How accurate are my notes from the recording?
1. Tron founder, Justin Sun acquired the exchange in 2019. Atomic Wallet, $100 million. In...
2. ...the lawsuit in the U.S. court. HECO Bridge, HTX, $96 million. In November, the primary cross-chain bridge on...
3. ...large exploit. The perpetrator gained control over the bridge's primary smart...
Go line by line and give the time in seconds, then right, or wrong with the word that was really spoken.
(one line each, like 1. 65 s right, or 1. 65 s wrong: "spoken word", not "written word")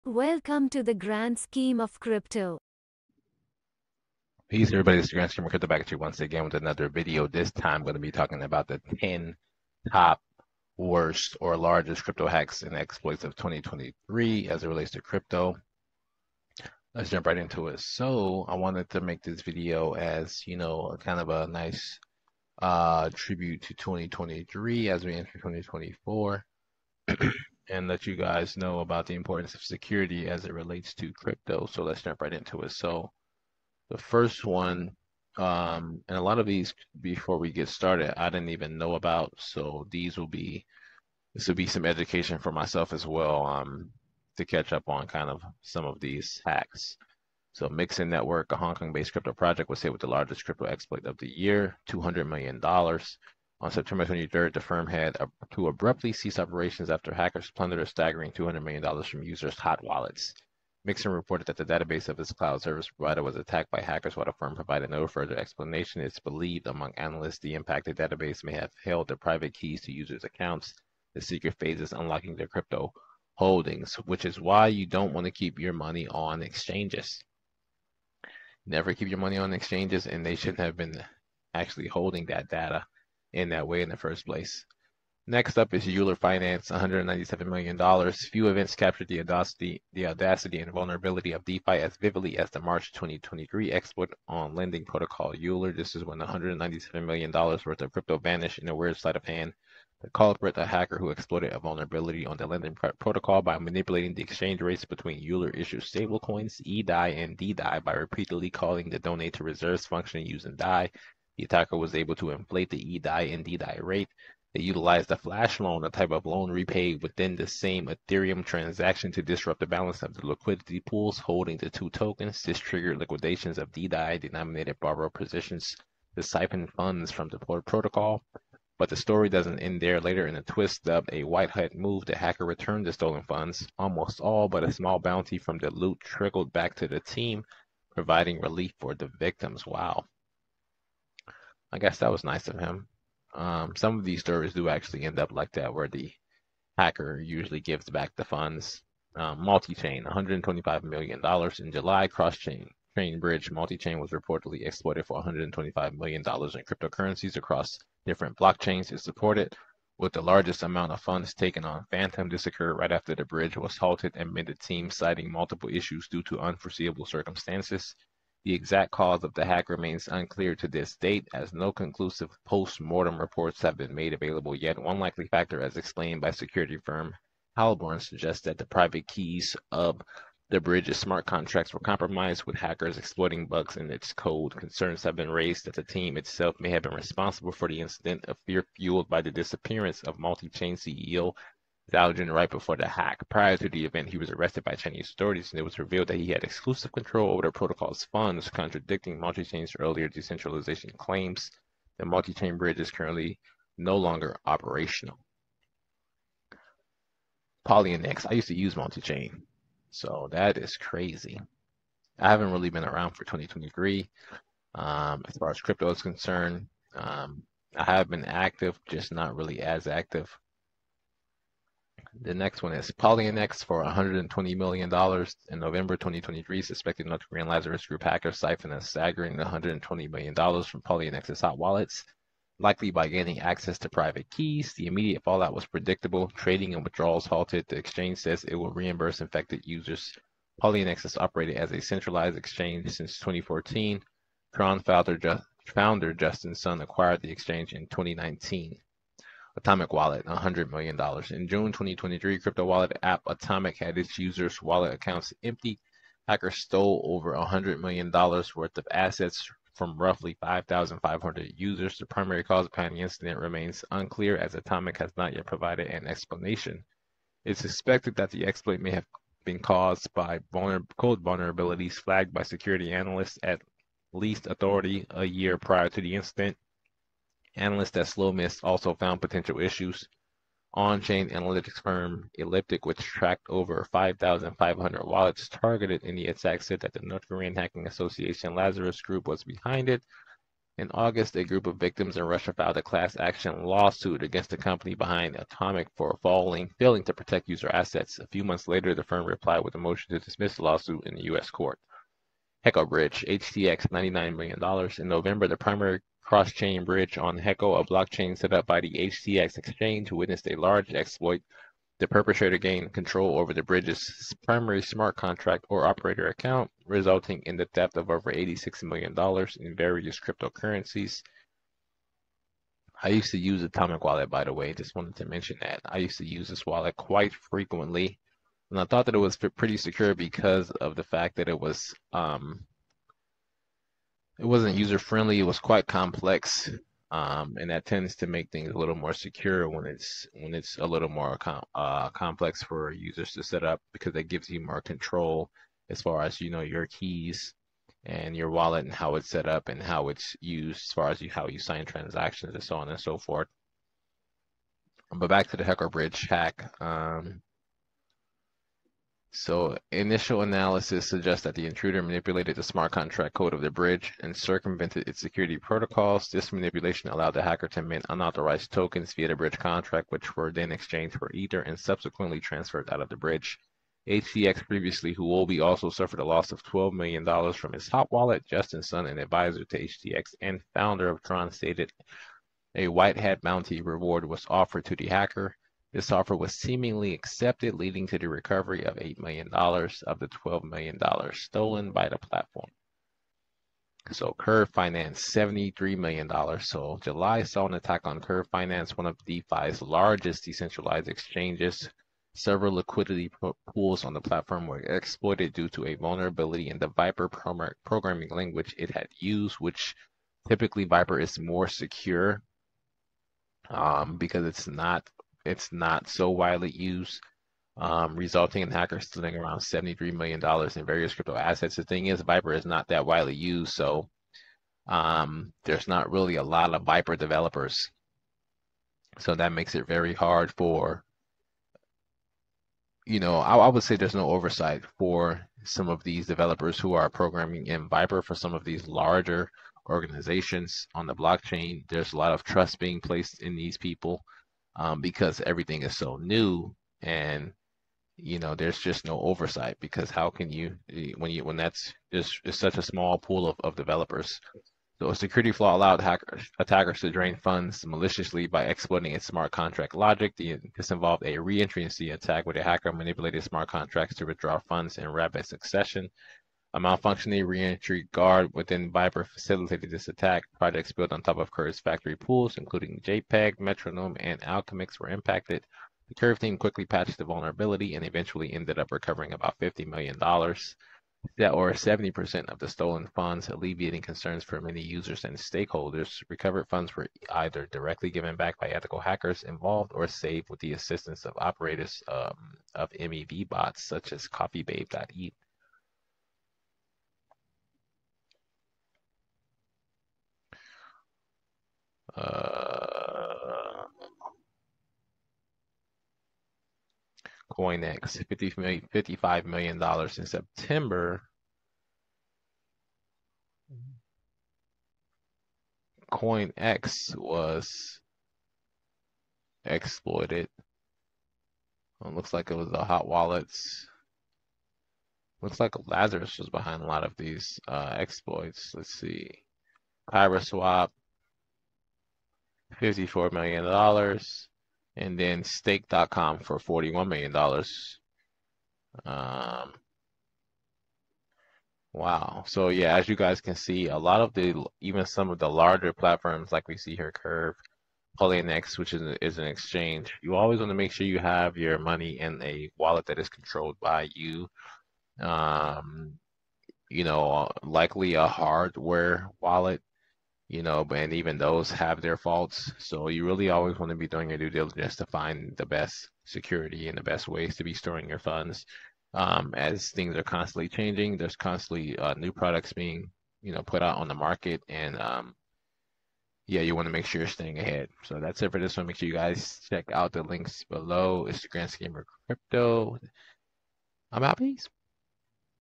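1. 244 s right
2. 300 s wrong: "99", not "96"
3. 310 s right.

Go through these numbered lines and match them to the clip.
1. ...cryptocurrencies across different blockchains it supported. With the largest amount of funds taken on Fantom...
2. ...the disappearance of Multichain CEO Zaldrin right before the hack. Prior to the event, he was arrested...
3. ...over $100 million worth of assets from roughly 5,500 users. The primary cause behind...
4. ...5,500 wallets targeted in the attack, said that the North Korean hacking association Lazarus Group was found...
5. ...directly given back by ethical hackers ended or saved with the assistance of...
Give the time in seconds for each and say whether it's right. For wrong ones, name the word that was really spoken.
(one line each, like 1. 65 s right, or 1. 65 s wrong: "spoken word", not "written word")
1. 156 s right
2. 189 s right
3. 257 s right
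4. 283 s wrong: "behind", not "found"
5. 487 s wrong: "involved", not "ended".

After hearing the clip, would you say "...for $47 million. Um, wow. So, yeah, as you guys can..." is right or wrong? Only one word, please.
wrong.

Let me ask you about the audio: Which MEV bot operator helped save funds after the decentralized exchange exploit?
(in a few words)
CoffeeBabe.eth.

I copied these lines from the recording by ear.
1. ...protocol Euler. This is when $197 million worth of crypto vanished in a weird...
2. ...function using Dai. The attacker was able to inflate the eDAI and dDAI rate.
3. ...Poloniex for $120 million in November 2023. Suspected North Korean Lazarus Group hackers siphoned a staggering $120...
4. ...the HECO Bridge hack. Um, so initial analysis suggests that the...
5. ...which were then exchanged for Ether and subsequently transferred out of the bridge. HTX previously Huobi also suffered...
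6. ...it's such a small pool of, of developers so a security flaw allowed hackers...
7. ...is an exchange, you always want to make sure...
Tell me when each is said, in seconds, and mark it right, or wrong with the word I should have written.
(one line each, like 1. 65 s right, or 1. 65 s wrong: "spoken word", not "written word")
1. 94 s right
2. 109 s right
3. 222 s right
4. 355 s right
5. 370 s right
6. 452 s right
7. 549 s right.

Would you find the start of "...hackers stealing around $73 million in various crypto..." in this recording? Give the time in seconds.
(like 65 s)
418 s.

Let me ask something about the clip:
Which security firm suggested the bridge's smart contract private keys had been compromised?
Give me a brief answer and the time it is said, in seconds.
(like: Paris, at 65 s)
Halborn, at 177 s.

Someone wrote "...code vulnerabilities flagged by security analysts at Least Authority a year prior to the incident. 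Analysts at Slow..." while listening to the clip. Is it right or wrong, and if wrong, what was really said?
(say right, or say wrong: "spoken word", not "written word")
right.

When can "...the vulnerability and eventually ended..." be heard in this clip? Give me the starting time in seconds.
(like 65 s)
477 s.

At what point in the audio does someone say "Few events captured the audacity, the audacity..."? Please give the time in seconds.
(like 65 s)
88 s.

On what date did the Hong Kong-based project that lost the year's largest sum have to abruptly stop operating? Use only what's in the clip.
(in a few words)
September 23rd.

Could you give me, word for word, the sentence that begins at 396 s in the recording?
So July saw an attack on Curve Finance, one of DeFi's largest decentralized exchanges.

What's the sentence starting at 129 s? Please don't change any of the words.
Later in a twist dubbed a White Hat move, the hacker returned the stolen funds.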